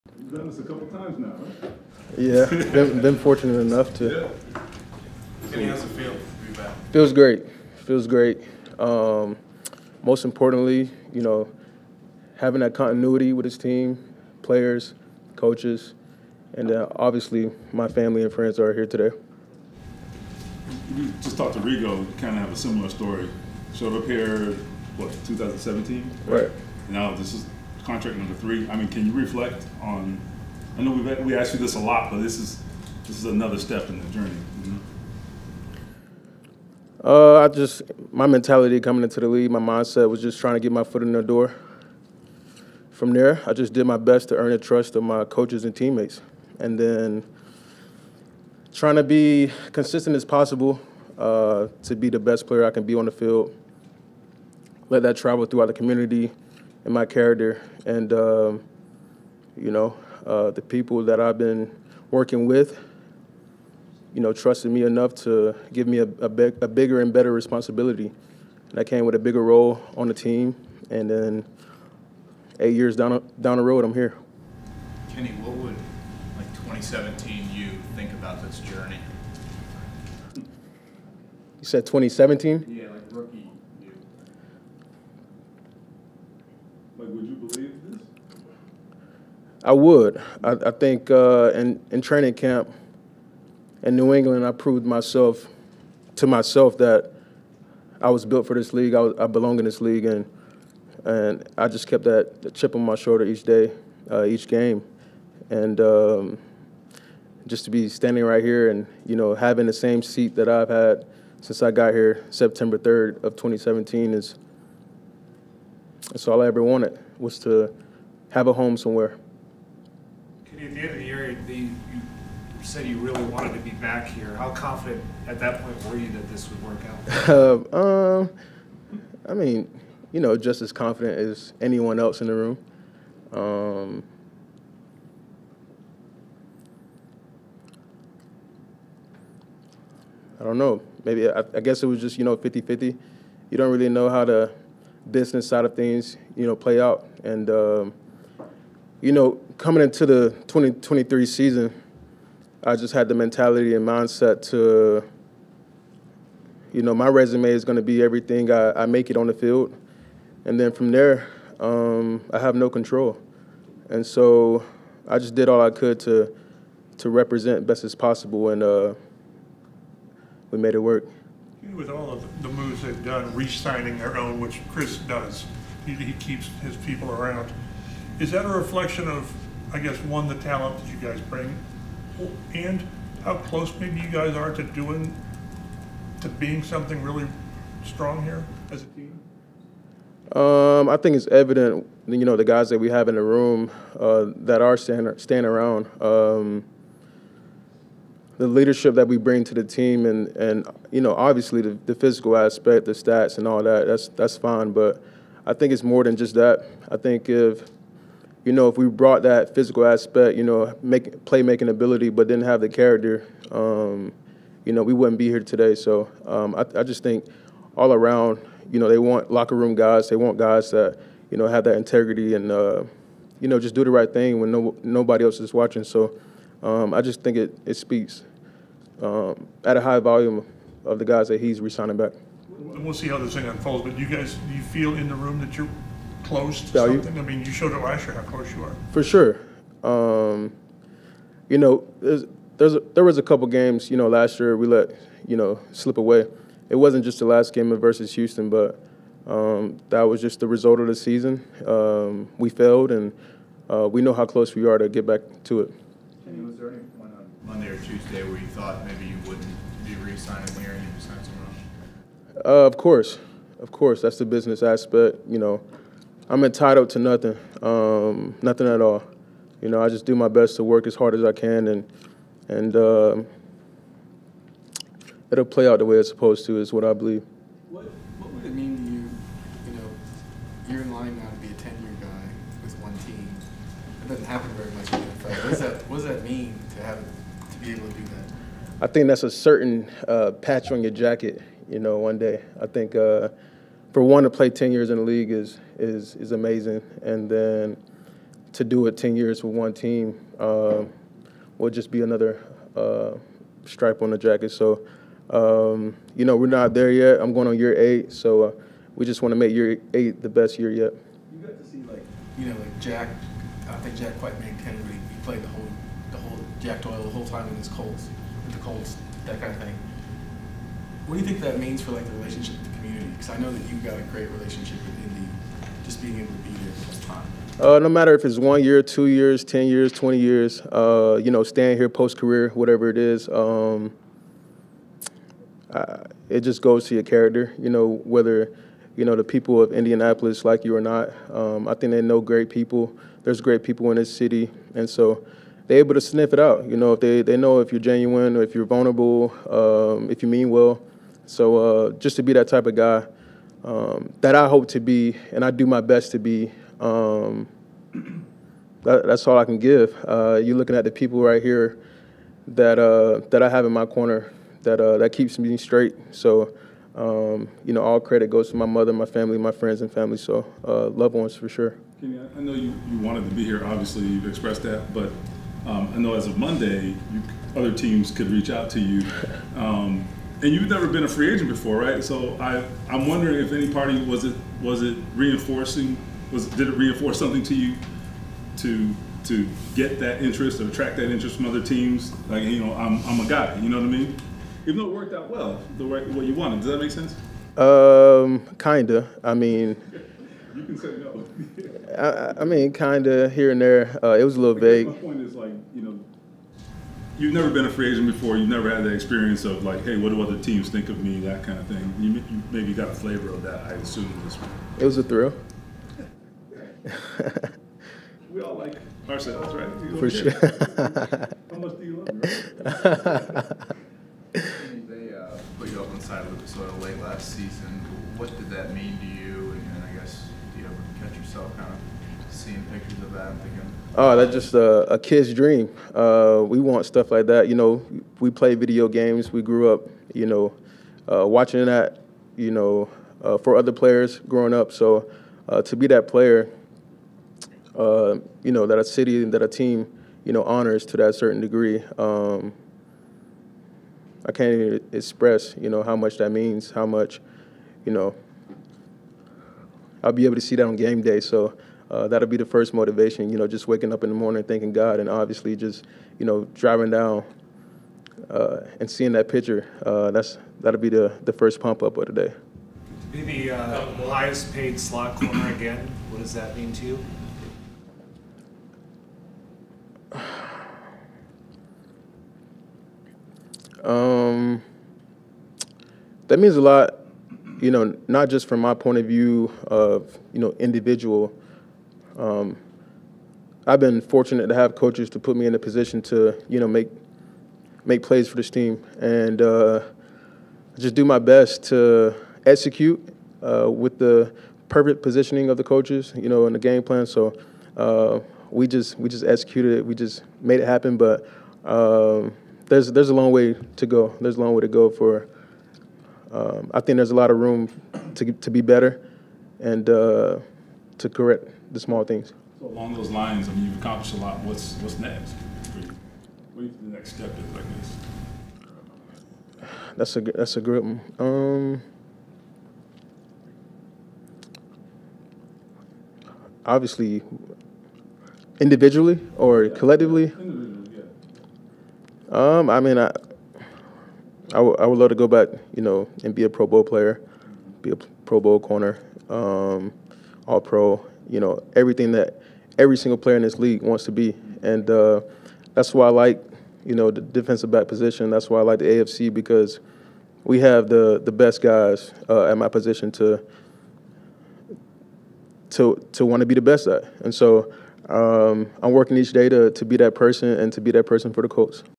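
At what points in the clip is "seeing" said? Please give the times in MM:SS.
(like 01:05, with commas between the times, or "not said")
07:12, 07:48.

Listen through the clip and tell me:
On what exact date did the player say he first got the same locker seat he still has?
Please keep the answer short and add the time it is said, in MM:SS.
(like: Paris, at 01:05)
September 3rd, 2017, at 01:52.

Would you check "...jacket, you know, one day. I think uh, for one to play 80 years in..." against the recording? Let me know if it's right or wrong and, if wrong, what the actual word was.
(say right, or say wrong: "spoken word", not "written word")
wrong: "10", not "80".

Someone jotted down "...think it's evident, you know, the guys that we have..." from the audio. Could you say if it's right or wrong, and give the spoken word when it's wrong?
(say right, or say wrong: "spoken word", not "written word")
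right.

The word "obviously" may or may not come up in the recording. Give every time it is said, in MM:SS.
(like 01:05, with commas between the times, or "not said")
00:16, 03:21, 06:13, 07:45, 08:56.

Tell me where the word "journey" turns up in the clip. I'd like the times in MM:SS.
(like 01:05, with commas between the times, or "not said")
00:34, 01:18.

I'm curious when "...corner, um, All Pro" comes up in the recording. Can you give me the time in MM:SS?
09:08.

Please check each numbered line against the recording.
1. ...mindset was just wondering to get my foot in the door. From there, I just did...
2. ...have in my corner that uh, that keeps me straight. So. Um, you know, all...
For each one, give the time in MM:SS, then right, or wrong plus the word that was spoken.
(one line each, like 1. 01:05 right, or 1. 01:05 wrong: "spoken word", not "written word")
1. 00:39 wrong: "trying", not "wondering"
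2. 06:03 right.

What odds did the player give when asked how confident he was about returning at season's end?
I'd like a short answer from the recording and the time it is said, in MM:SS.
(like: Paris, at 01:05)
50-50, at 02:22.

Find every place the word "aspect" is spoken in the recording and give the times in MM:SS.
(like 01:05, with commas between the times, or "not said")
03:22, 03:29, 04:24.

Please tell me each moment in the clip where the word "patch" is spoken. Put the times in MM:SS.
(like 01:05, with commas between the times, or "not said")
04:50.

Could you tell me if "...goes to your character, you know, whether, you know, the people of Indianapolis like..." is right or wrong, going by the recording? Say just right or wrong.
right.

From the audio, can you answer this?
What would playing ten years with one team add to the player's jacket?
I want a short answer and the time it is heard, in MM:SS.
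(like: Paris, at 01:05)
stripe, at 05:03.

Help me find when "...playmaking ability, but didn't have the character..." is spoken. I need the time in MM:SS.
03:31.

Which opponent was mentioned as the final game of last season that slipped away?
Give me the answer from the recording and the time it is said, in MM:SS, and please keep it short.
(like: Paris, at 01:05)
Houston, at 04:08.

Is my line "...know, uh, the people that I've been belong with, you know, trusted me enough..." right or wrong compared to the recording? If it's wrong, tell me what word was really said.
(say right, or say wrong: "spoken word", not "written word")
wrong: "working", not "belong".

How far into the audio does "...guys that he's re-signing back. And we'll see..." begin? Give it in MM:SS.
03:51.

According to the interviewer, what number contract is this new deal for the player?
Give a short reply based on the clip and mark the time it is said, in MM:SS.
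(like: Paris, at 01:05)
3, at 00:28.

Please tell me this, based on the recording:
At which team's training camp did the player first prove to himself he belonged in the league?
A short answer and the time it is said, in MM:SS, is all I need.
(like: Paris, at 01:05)
New England, at 01:33.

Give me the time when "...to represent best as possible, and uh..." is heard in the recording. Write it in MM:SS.
02:46.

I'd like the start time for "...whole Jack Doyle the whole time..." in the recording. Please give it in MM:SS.
05:15.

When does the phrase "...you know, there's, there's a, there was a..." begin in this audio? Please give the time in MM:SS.
04:01.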